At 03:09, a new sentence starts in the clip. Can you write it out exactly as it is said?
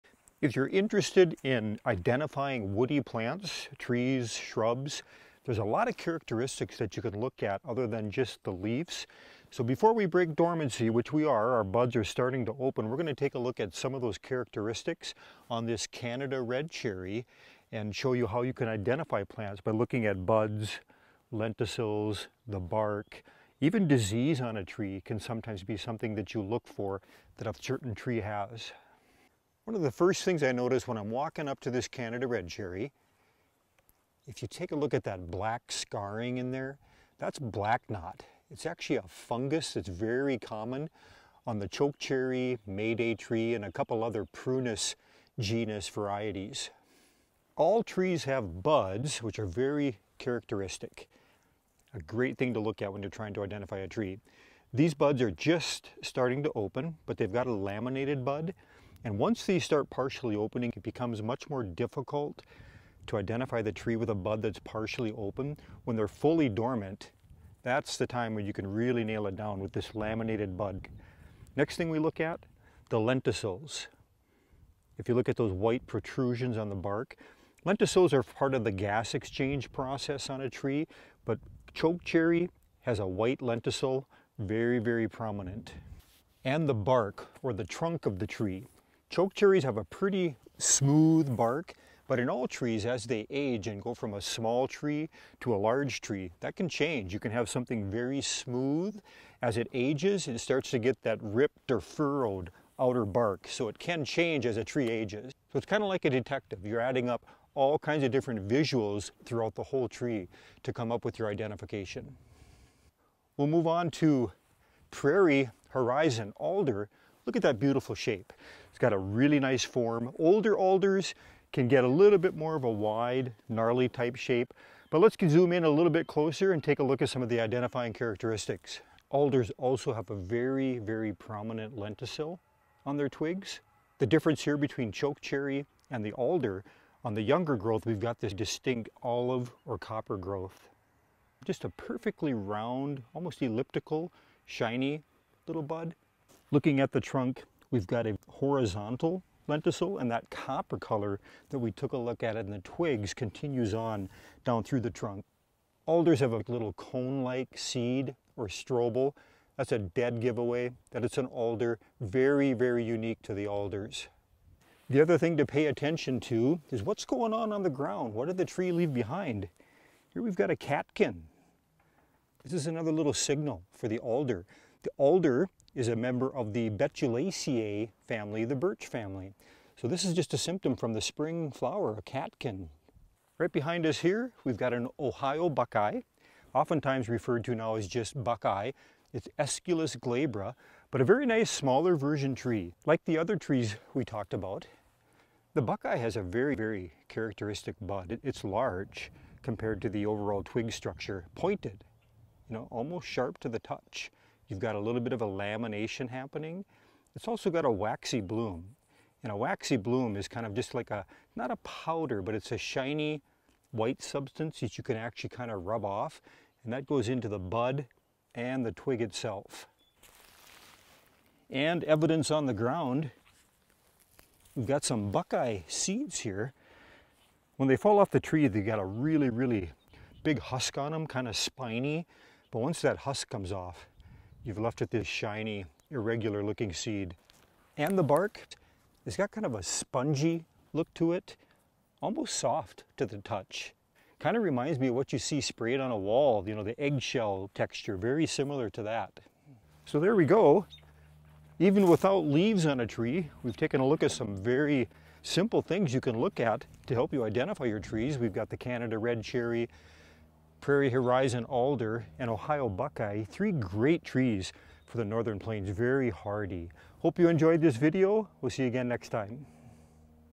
It's Aesculus glabra, but a very nice smaller version tree.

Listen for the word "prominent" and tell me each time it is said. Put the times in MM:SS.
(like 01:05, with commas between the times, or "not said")
01:25, 02:11.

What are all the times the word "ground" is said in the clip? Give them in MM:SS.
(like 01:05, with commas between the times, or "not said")
02:47, 03:42.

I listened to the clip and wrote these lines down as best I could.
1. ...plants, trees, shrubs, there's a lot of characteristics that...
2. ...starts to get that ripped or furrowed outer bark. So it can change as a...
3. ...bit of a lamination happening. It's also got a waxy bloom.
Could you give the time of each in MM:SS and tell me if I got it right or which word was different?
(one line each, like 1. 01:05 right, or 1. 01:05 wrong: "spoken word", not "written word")
1. 00:02 right
2. 01:40 right
3. 03:24 right.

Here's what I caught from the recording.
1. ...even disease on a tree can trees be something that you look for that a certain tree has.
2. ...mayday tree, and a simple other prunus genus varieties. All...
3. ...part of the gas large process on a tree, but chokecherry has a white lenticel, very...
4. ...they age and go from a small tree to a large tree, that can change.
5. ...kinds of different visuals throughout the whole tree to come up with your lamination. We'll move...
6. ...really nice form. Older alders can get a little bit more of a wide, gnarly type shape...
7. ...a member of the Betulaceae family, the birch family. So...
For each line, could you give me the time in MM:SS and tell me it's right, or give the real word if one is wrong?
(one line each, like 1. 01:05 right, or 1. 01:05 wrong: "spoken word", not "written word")
1. 00:23 wrong: "sometimes", not "trees"
2. 00:42 wrong: "couple", not "simple"
3. 01:18 wrong: "exchange", not "large"
4. 01:33 right
5. 01:47 wrong: "identification", not "lamination"
6. 01:58 right
7. 02:55 right.